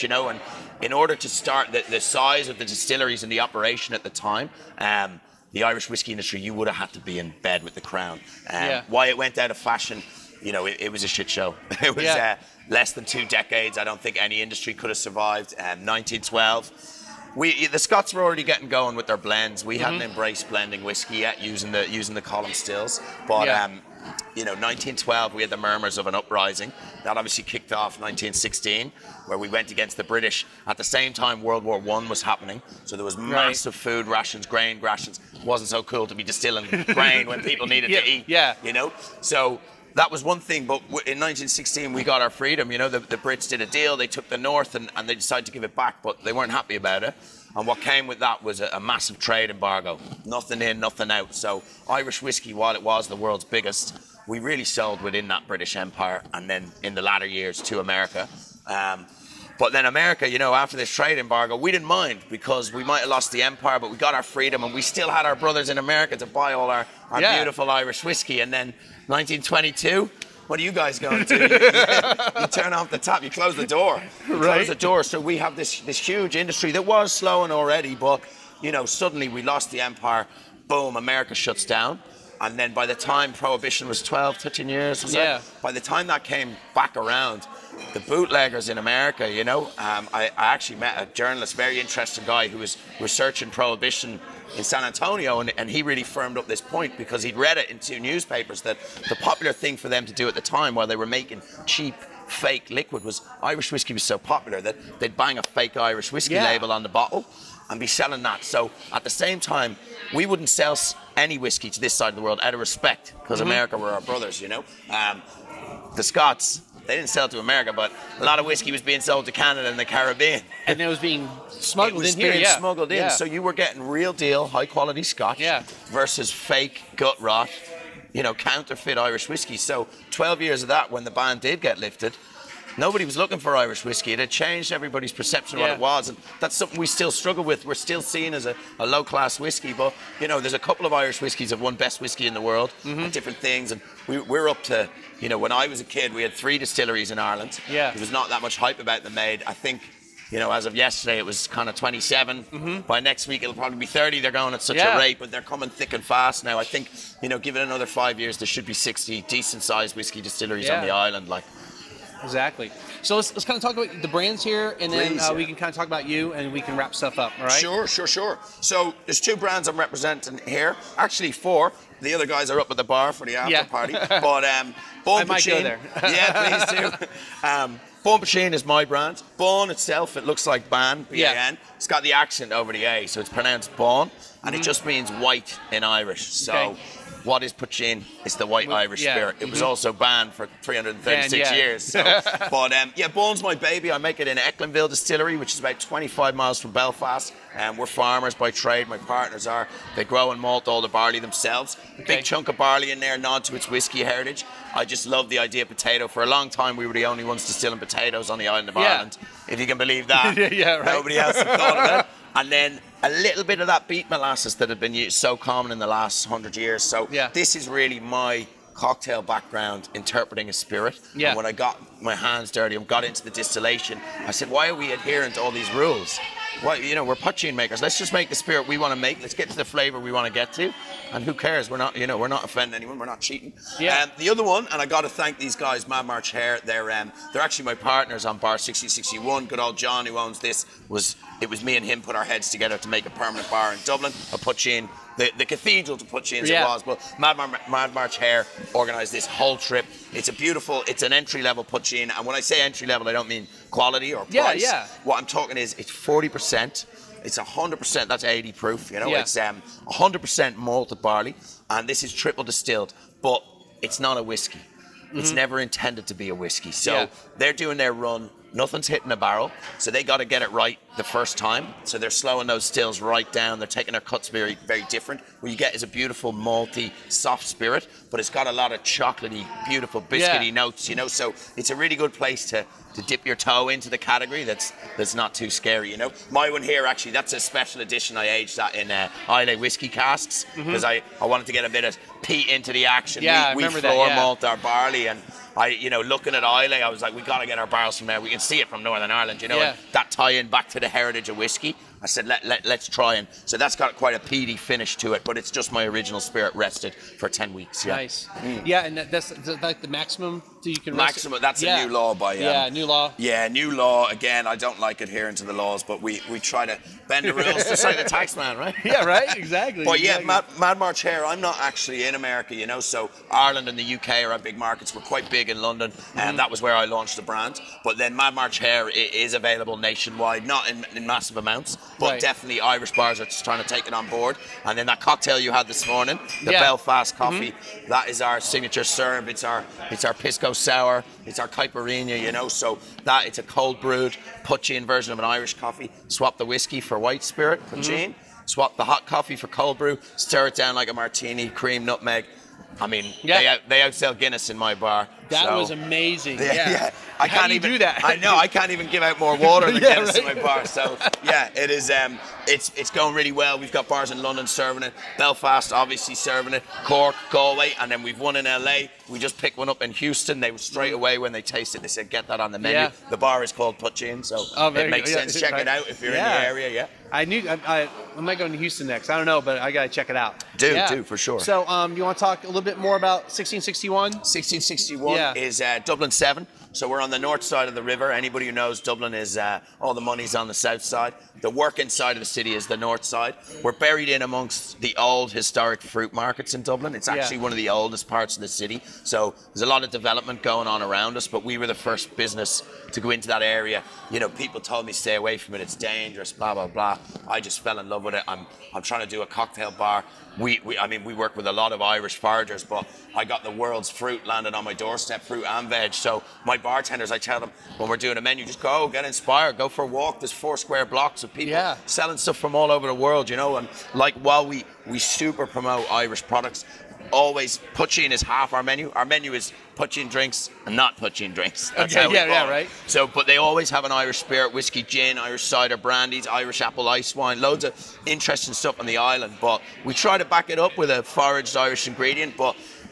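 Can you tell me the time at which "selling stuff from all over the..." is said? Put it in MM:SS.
07:01.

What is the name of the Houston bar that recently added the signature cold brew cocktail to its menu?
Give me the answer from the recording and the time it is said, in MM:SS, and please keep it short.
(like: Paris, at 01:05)
Put You In, at 06:13.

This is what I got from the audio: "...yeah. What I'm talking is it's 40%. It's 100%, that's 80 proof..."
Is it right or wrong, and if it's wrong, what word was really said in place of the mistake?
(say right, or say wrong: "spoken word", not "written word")
right.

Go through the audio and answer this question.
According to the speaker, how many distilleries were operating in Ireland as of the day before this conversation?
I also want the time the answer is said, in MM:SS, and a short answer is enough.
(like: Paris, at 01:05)
27, at 02:31.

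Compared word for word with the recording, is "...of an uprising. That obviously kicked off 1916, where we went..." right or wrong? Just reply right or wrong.
right.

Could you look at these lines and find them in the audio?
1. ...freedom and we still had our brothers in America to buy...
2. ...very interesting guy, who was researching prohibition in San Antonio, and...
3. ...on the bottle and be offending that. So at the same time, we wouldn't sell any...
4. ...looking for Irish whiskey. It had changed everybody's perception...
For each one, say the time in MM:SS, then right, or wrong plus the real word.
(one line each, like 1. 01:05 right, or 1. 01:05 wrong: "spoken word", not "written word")
1. 01:04 right
2. 01:31 right
3. 01:46 wrong: "selling", not "offending"
4. 02:13 right.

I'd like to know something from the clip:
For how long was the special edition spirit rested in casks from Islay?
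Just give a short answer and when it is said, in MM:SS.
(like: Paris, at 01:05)
10 weeks, at 05:07.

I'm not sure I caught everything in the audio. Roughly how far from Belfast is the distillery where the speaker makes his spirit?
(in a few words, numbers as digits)
25 miles.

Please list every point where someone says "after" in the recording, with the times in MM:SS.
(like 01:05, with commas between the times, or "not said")
01:00, 02:53.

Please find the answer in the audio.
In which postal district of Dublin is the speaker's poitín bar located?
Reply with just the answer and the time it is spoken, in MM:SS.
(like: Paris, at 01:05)
Dublin 7, at 06:25.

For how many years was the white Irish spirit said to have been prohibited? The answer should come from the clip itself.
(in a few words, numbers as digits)
336.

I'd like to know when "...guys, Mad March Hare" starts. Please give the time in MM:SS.
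03:55.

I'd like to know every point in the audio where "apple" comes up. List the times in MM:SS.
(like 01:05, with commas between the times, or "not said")
07:16.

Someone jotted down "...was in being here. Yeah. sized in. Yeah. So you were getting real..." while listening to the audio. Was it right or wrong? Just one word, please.
wrong.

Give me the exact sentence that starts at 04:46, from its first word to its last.
My one here actually, that's a special edition.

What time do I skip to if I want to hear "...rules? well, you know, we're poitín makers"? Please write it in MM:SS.
03:45.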